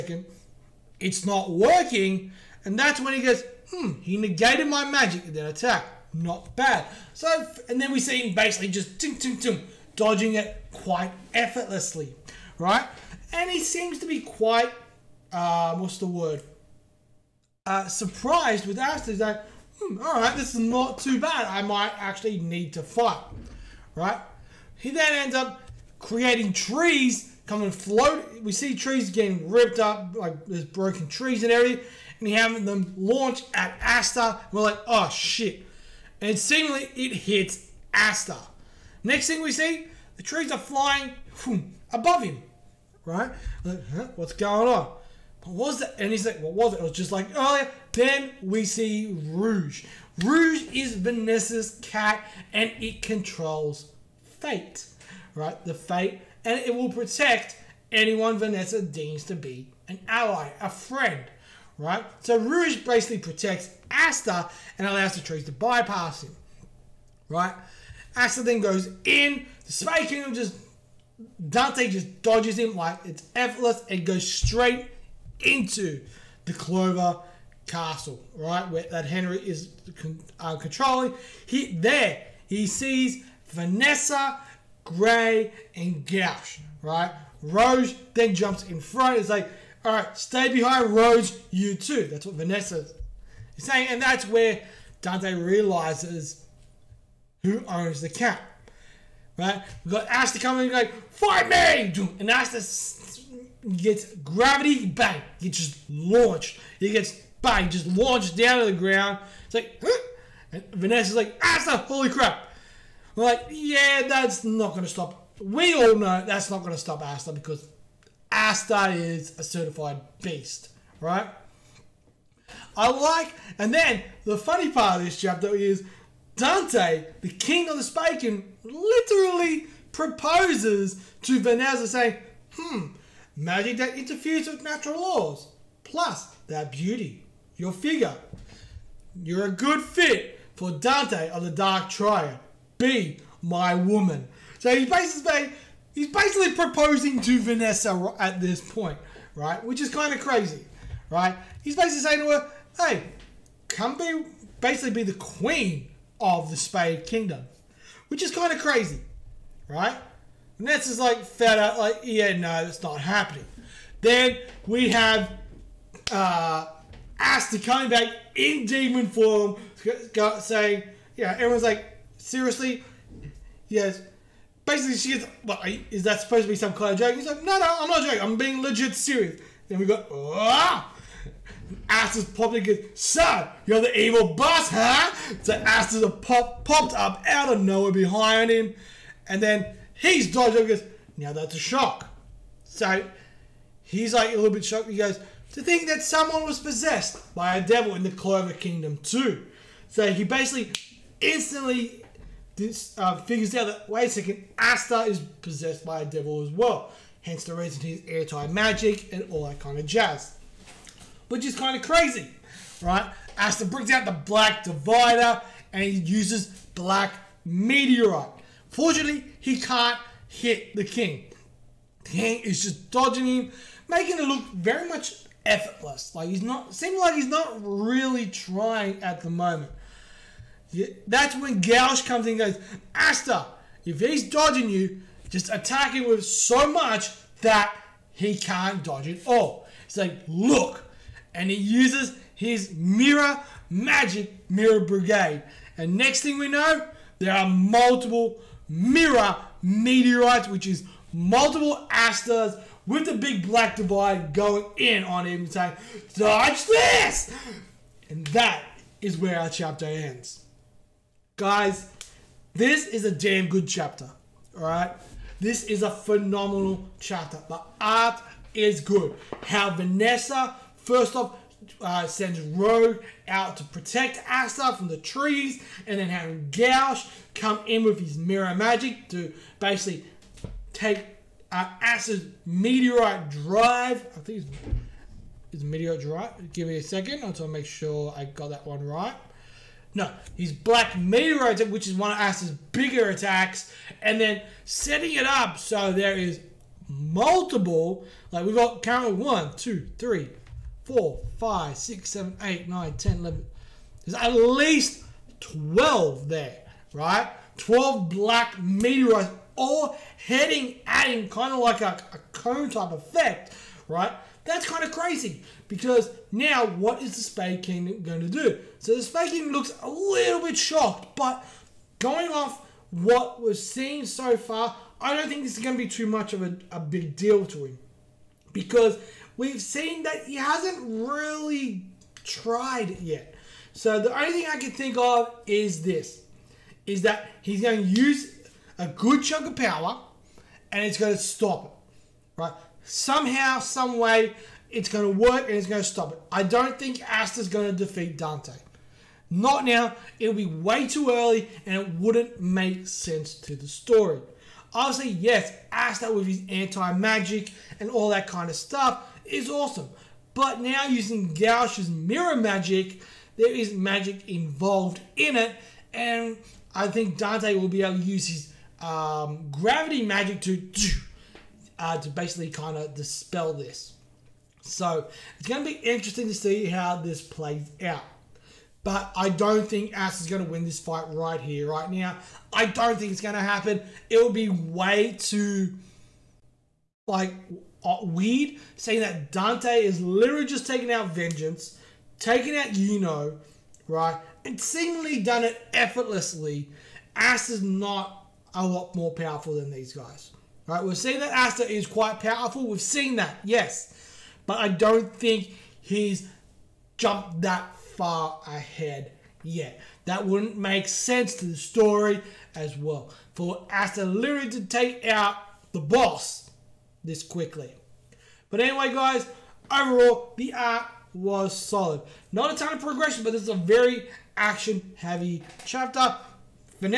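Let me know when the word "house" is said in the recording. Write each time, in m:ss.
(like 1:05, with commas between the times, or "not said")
not said.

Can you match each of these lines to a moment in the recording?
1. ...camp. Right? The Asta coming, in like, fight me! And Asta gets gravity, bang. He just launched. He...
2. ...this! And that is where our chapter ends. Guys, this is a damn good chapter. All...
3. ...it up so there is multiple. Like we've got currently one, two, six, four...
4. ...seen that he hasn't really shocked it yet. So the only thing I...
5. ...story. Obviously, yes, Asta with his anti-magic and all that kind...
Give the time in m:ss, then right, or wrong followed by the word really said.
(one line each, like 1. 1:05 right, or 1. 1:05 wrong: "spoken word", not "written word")
1. 1:38 right
2. 4:16 right
3. 4:55 wrong: "three", not "six"
4. 5:29 wrong: "tried", not "shocked"
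5. 5:53 right.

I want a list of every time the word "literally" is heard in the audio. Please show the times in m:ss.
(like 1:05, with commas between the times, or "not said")
2:08, 6:30, 6:54.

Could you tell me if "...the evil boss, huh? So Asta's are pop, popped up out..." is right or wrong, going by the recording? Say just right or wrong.
right.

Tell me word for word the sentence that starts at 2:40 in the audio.
Vanessa's like fed up, like, yeah, no, that's not happening.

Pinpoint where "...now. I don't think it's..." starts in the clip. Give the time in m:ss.
6:21.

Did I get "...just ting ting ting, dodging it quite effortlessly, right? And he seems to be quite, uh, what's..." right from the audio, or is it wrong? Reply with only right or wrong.
right.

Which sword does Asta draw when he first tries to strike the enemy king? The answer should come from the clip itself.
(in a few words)
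Black Divider.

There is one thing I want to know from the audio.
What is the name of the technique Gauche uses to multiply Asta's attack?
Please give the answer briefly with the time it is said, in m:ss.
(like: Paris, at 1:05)
Mirror Brigade, at 4:04.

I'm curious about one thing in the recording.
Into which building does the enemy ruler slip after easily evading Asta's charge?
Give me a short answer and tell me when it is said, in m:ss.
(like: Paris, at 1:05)
Clover Castle, at 1:16.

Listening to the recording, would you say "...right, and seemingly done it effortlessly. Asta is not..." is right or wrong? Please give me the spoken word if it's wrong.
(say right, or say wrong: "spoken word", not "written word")
right.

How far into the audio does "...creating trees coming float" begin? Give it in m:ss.
0:25.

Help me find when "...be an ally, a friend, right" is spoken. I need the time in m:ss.
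0:59.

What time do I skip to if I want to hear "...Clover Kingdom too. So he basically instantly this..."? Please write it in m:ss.
3:18.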